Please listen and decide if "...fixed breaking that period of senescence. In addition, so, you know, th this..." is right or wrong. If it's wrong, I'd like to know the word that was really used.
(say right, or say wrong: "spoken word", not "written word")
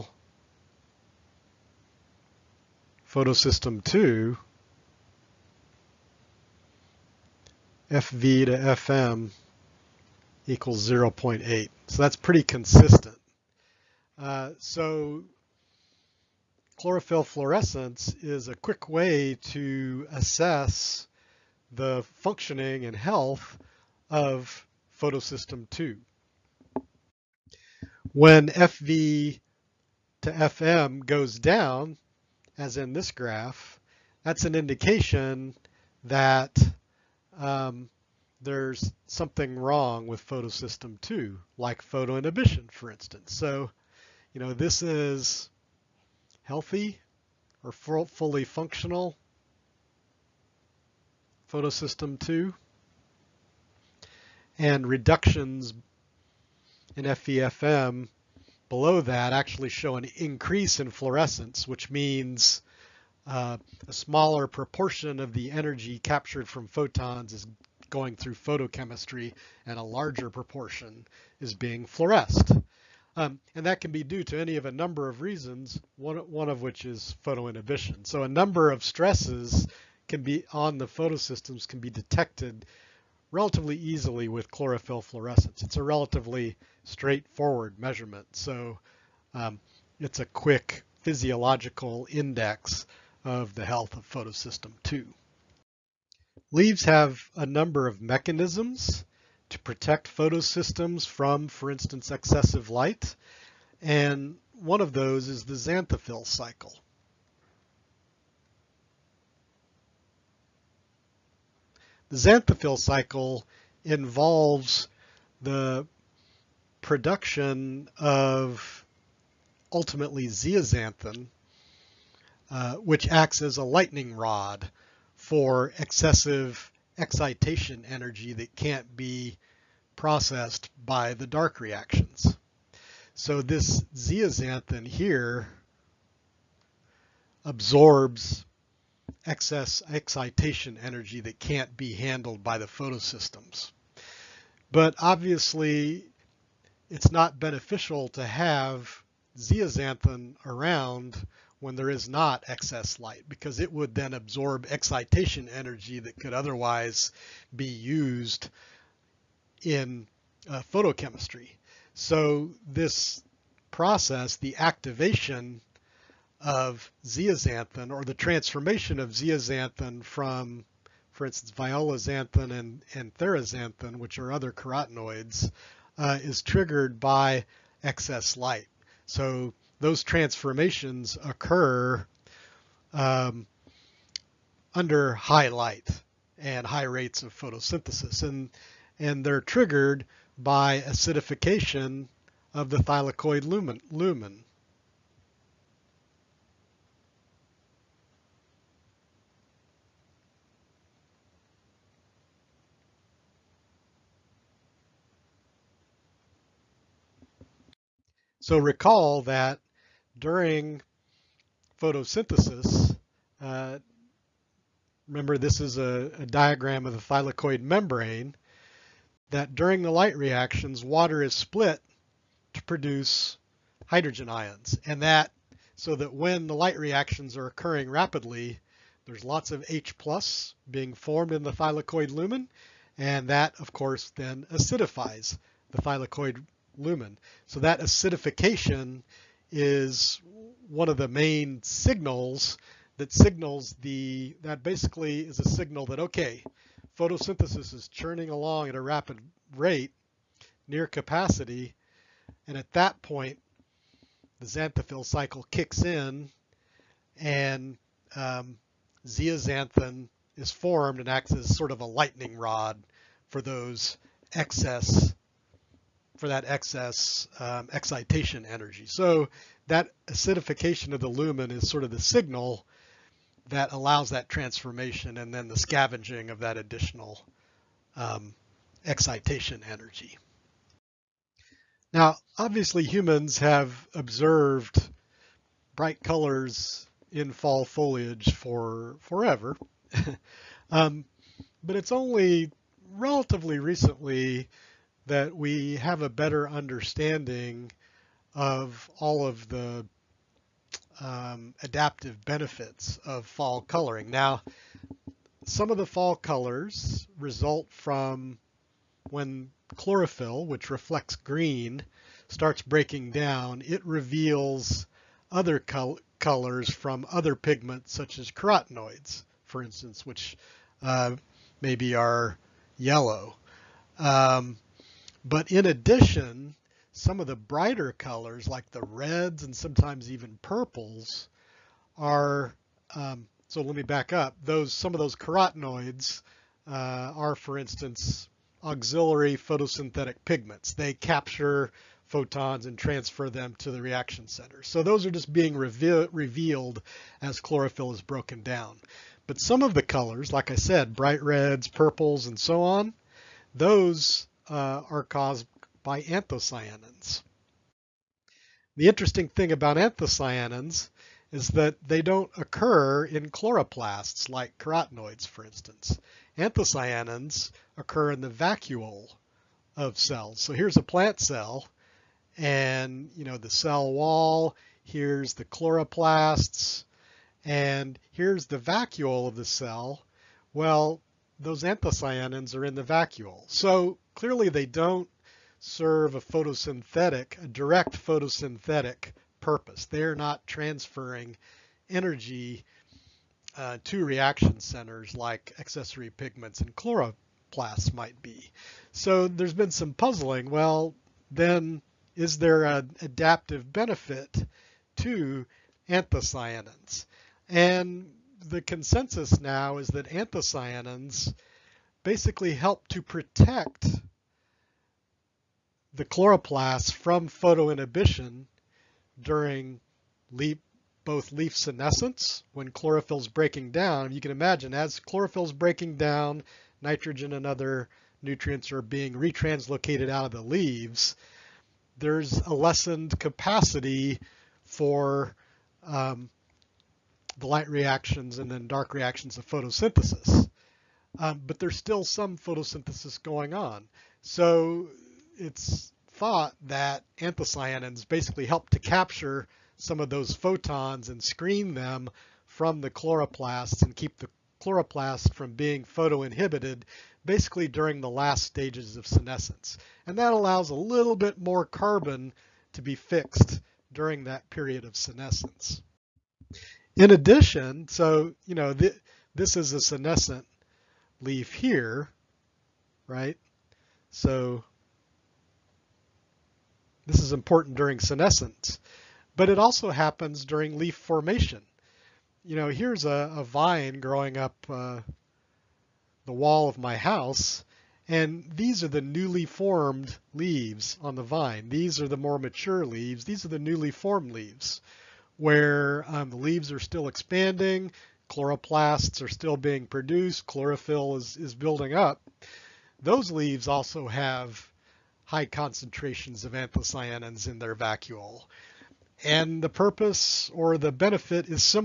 wrong: "during", not "breaking".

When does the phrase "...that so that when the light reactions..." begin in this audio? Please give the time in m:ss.
3:45.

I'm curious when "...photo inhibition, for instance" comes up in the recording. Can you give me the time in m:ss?
0:41.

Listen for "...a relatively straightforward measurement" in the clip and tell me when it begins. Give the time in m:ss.
1:25.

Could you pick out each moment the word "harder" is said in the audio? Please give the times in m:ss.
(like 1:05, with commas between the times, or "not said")
not said.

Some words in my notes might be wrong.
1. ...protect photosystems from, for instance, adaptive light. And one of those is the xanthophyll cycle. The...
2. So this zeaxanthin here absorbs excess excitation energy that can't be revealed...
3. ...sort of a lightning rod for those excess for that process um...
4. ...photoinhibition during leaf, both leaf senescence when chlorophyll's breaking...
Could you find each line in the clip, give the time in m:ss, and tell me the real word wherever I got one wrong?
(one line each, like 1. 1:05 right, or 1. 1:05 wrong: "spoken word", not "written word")
1. 1:39 wrong: "excessive", not "adaptive"
2. 2:13 wrong: "handled", not "revealed"
3. 4:21 wrong: "excess", not "process"
4. 6:57 right.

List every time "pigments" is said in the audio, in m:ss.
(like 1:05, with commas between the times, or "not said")
5:17, 5:40, 6:36.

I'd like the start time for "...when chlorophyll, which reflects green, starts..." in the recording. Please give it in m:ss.
5:09.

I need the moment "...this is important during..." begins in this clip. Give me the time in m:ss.
7:57.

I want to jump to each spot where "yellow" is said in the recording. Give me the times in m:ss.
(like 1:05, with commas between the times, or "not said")
5:22.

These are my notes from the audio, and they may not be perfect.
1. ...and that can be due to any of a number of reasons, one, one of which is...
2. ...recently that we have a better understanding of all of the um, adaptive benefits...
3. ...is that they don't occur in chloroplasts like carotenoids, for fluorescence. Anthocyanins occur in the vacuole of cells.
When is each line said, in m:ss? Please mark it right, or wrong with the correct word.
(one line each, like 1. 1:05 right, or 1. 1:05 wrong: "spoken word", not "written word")
1. 1:13 right
2. 4:53 right
3. 6:01 wrong: "instance", not "fluorescence".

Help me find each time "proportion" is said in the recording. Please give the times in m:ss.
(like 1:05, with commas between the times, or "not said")
1:04, 1:10.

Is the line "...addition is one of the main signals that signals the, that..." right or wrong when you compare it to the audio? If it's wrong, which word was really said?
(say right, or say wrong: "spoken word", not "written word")
wrong: "acidification", not "addition".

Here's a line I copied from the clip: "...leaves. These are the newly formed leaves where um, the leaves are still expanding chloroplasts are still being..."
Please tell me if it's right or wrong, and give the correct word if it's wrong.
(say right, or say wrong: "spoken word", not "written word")
right.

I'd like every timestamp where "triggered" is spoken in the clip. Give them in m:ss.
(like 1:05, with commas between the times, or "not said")
2:56, 3:09.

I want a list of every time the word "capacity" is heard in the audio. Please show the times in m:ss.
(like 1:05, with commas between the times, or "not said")
4:10, 7:13.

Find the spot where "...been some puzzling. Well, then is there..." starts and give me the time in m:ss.
6:39.